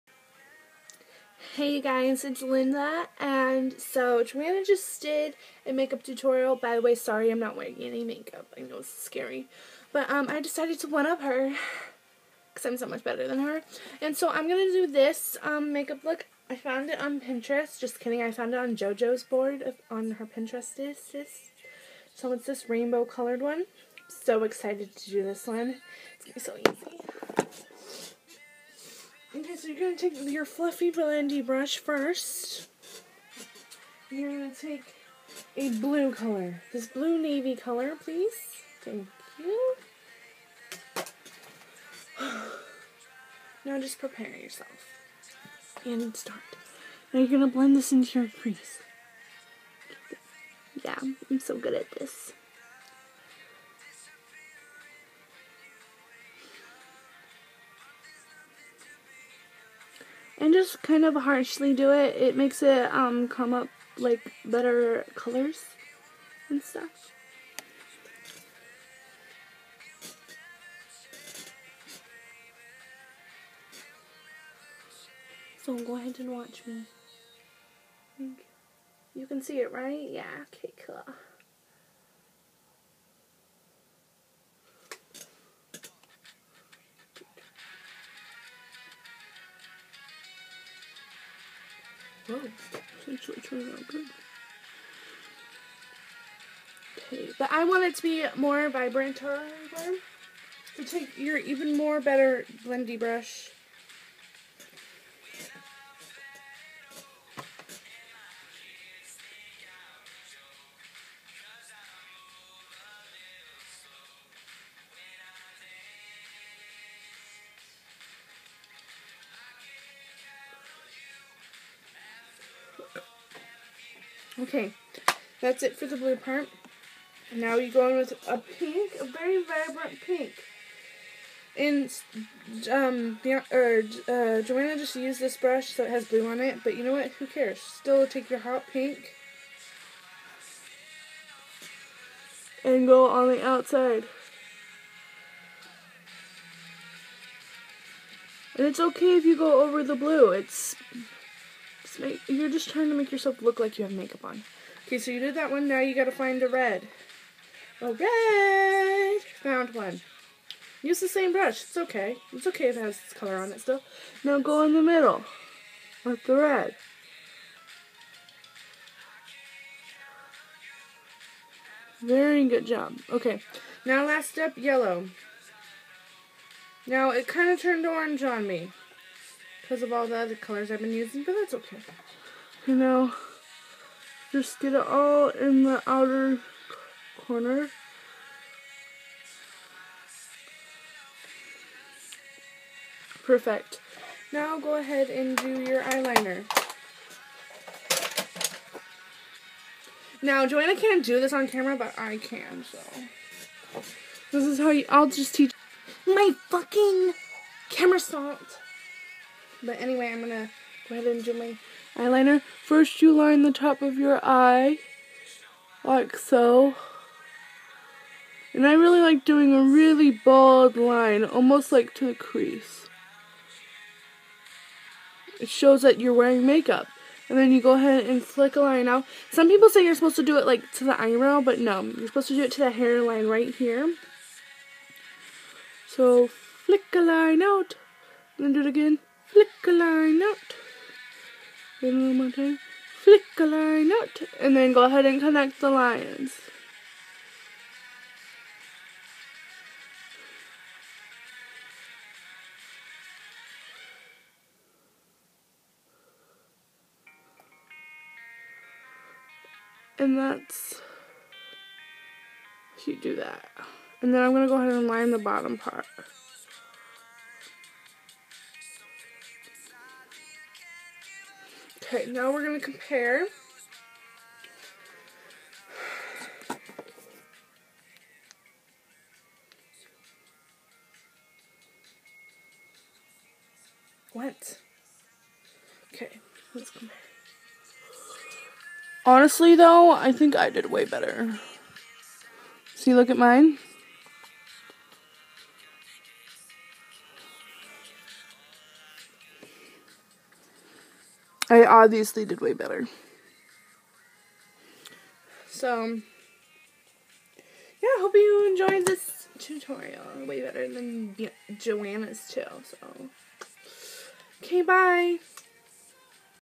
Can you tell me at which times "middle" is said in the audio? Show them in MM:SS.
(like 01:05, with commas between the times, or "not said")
02:44.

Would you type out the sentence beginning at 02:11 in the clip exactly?
And um, or, uh, Joanna just used this brush so it has blue on it, but you know what?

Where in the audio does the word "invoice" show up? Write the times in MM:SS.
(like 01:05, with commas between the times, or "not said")
not said.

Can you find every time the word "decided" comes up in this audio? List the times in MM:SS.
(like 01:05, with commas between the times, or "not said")
00:10.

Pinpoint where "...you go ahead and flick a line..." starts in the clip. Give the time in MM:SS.
03:47.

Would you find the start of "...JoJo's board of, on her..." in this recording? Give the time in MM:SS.
00:18.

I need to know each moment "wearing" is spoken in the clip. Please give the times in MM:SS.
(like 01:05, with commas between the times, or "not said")
00:07, 03:46.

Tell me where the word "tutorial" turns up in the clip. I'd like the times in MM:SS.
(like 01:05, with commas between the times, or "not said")
00:06, 05:09.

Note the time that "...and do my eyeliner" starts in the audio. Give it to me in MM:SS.
03:31.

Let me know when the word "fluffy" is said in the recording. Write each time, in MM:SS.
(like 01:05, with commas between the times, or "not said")
00:30.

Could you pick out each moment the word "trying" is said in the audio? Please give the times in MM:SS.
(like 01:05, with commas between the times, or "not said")
02:32.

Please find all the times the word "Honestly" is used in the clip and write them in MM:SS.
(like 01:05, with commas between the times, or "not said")
04:49.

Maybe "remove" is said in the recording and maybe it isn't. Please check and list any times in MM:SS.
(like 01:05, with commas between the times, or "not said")
not said.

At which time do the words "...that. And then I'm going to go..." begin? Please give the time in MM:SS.
04:23.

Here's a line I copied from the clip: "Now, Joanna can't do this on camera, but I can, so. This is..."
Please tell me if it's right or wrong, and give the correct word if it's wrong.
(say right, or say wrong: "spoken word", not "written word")
right.